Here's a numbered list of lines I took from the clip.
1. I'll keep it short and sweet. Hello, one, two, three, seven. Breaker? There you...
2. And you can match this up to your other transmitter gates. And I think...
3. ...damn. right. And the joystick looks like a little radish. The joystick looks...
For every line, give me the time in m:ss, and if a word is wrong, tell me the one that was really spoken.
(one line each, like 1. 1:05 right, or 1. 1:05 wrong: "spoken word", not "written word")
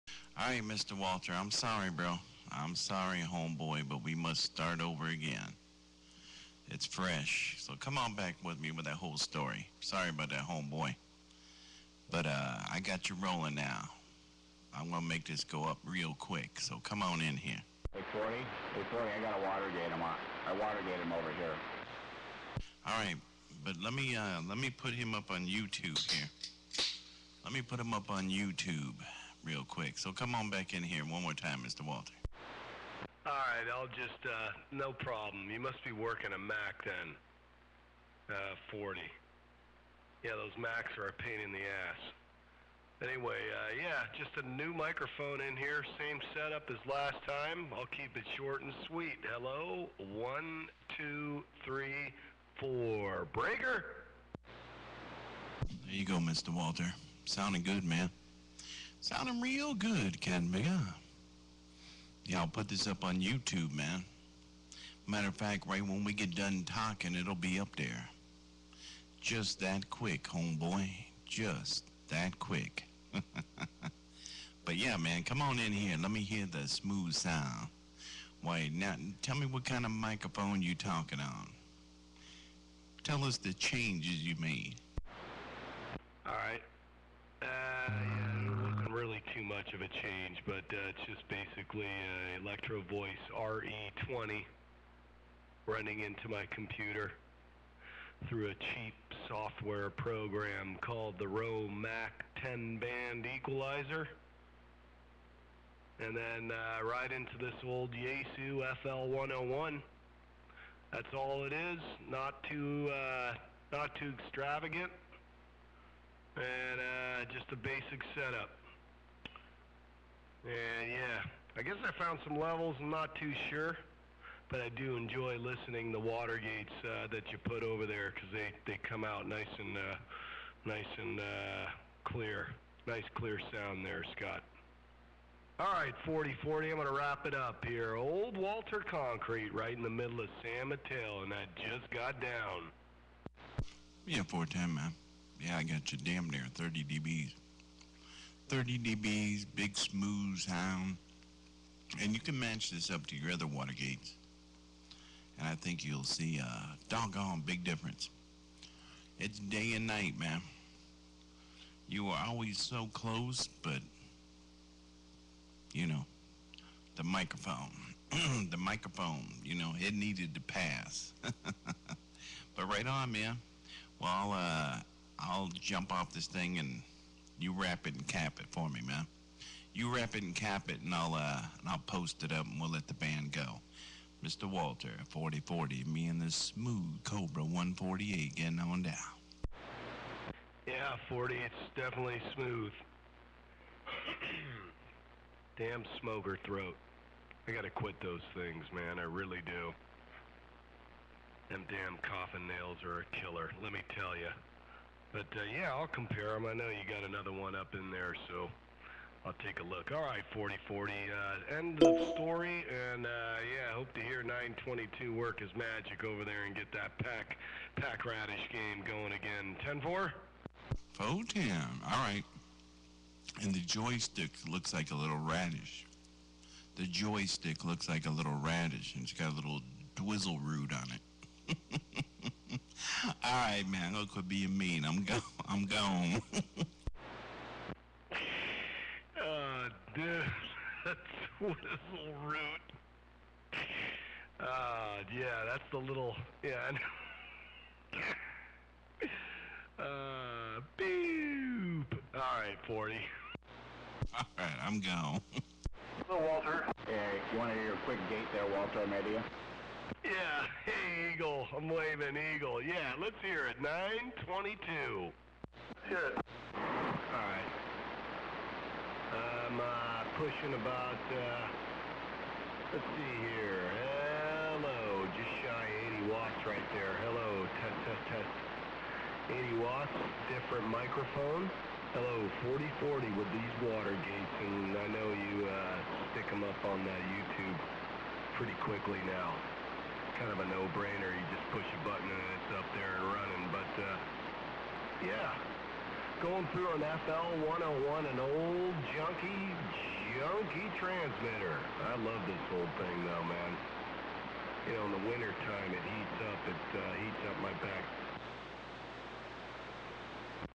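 1. 0:47 wrong: "four", not "seven"
2. 2:32 wrong: "water", not "transmitter"
3. 3:41 right.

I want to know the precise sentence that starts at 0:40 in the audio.
Yeah, those Macs are a pain in the ass.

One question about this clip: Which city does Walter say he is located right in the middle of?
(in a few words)
San Mateo.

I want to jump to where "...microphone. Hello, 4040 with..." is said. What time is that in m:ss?
4:40.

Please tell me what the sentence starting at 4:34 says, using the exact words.
Hello, just shy 80 watts right there.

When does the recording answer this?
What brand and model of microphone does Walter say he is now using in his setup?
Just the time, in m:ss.
1:32.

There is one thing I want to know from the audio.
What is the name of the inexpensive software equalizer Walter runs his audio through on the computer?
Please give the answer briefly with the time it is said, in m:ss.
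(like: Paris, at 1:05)
Romac 10 band equalizer, at 1:41.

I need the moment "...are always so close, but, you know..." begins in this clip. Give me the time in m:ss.
2:42.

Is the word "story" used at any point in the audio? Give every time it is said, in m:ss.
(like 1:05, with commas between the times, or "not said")
0:09, 3:32.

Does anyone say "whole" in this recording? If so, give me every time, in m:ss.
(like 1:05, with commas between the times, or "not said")
0:08, 5:02.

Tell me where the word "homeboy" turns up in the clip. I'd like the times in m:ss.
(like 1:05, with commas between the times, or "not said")
0:03, 0:10, 1:10.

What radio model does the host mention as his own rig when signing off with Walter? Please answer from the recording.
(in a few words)
Cobra 148.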